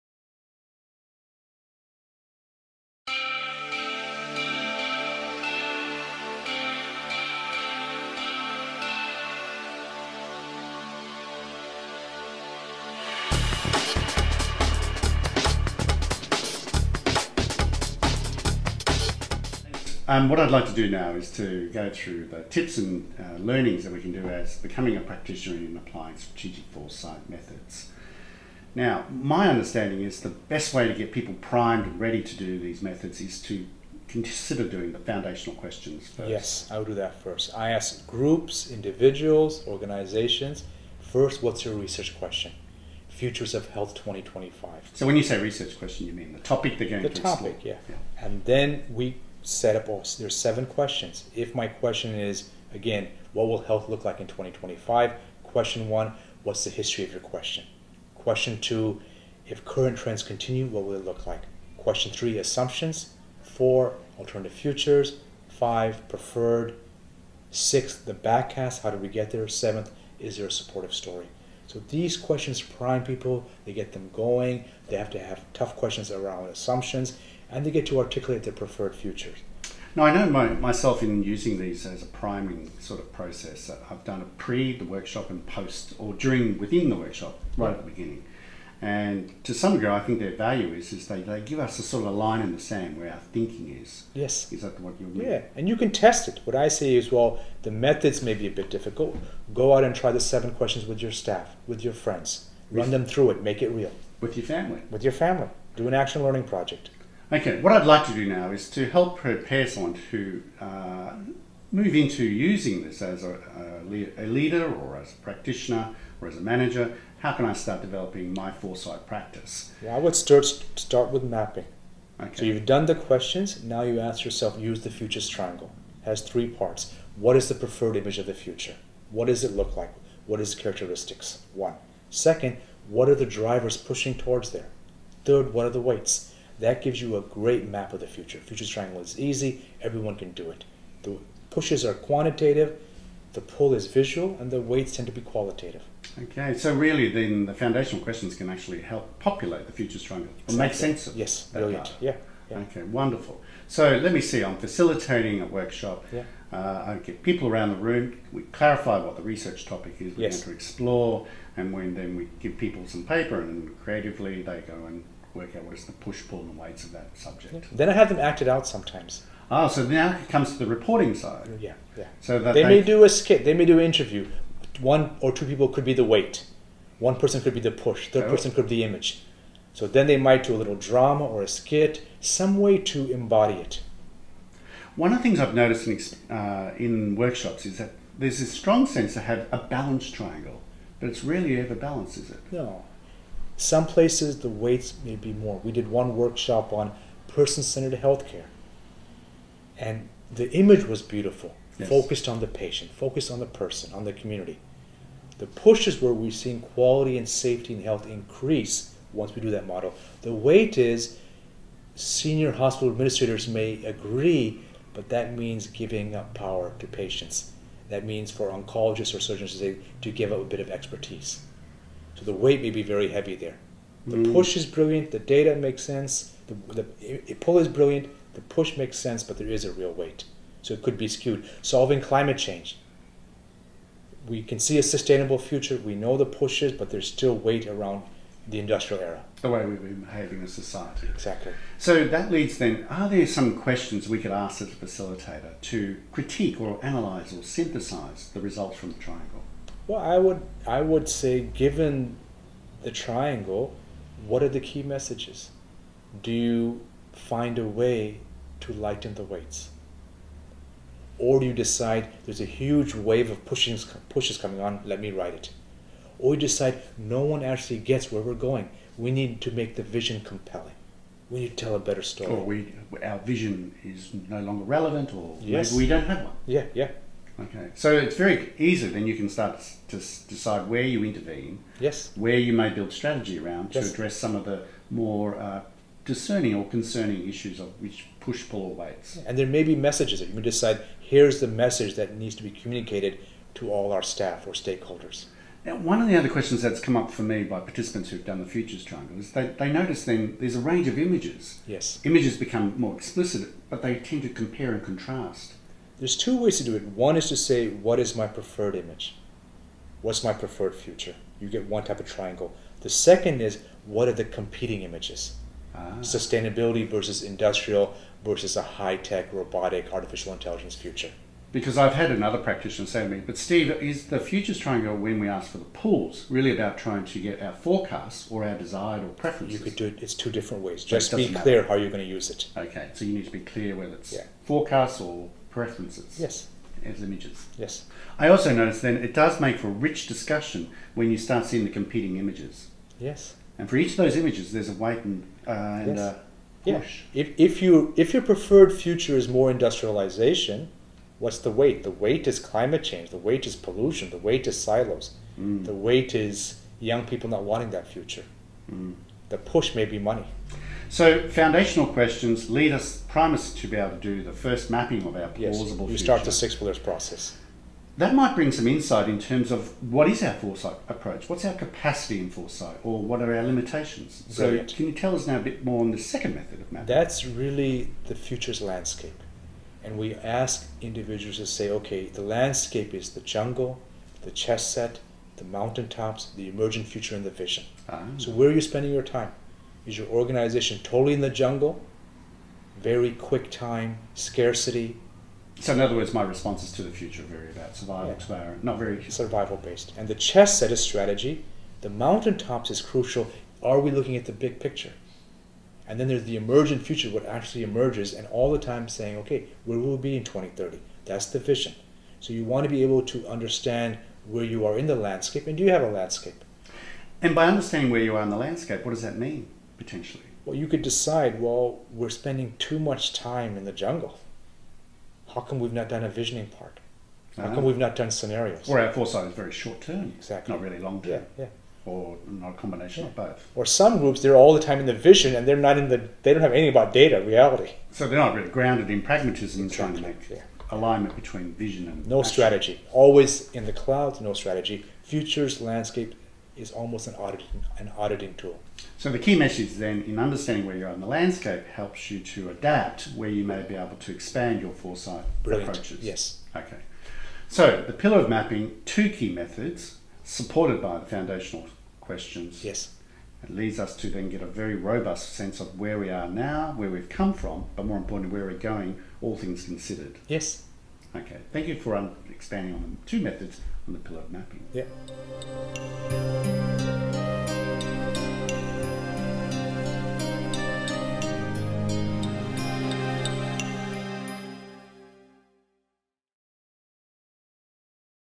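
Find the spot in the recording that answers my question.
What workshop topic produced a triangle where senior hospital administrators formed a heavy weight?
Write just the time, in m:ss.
3:17.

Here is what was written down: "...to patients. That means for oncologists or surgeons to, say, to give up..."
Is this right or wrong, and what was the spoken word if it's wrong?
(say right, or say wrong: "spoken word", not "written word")
right.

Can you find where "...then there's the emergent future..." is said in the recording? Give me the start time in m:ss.
6:45.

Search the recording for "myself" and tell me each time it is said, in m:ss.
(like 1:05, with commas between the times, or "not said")
1:20.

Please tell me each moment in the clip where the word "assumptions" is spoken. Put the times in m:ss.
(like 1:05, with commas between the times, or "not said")
1:02, 1:16.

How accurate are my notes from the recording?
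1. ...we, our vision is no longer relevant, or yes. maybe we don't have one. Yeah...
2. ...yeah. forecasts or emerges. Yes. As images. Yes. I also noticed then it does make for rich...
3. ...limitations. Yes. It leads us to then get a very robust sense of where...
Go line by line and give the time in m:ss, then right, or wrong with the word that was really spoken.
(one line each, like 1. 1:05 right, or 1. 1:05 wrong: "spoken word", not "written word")
1. 4:32 right
2. 5:34 wrong: "preferences", not "emerges"
3. 7:41 wrong: "questions", not "limitations".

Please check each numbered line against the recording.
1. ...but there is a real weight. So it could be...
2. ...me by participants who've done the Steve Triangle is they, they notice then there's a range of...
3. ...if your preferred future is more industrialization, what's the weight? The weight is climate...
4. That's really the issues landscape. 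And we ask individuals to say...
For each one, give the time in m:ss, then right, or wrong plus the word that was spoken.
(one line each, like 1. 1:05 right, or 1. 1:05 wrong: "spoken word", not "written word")
1. 3:49 right
2. 4:57 wrong: "Futures", not "Steve"
3. 5:47 right
4. 6:16 wrong: "futures", not "issues".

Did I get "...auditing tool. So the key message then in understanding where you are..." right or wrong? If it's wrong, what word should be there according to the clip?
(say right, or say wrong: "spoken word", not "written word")
right.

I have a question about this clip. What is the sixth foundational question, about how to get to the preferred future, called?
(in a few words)
The backcast.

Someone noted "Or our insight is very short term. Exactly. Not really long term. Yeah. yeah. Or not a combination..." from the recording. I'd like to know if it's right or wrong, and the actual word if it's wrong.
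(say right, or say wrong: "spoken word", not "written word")
wrong: "foresight", not "insight".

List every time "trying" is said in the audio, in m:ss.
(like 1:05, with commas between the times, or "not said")
5:26, 7:19.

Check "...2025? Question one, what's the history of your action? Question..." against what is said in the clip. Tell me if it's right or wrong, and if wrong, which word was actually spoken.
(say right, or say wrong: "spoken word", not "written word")
wrong: "question", not "action".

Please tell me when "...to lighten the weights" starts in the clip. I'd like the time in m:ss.
4:18.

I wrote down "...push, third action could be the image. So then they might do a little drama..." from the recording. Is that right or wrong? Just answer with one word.
wrong.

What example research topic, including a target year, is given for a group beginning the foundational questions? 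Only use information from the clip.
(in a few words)
Futures of Health 2025.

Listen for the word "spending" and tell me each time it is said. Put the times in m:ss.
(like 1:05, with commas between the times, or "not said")
6:28, 7:02.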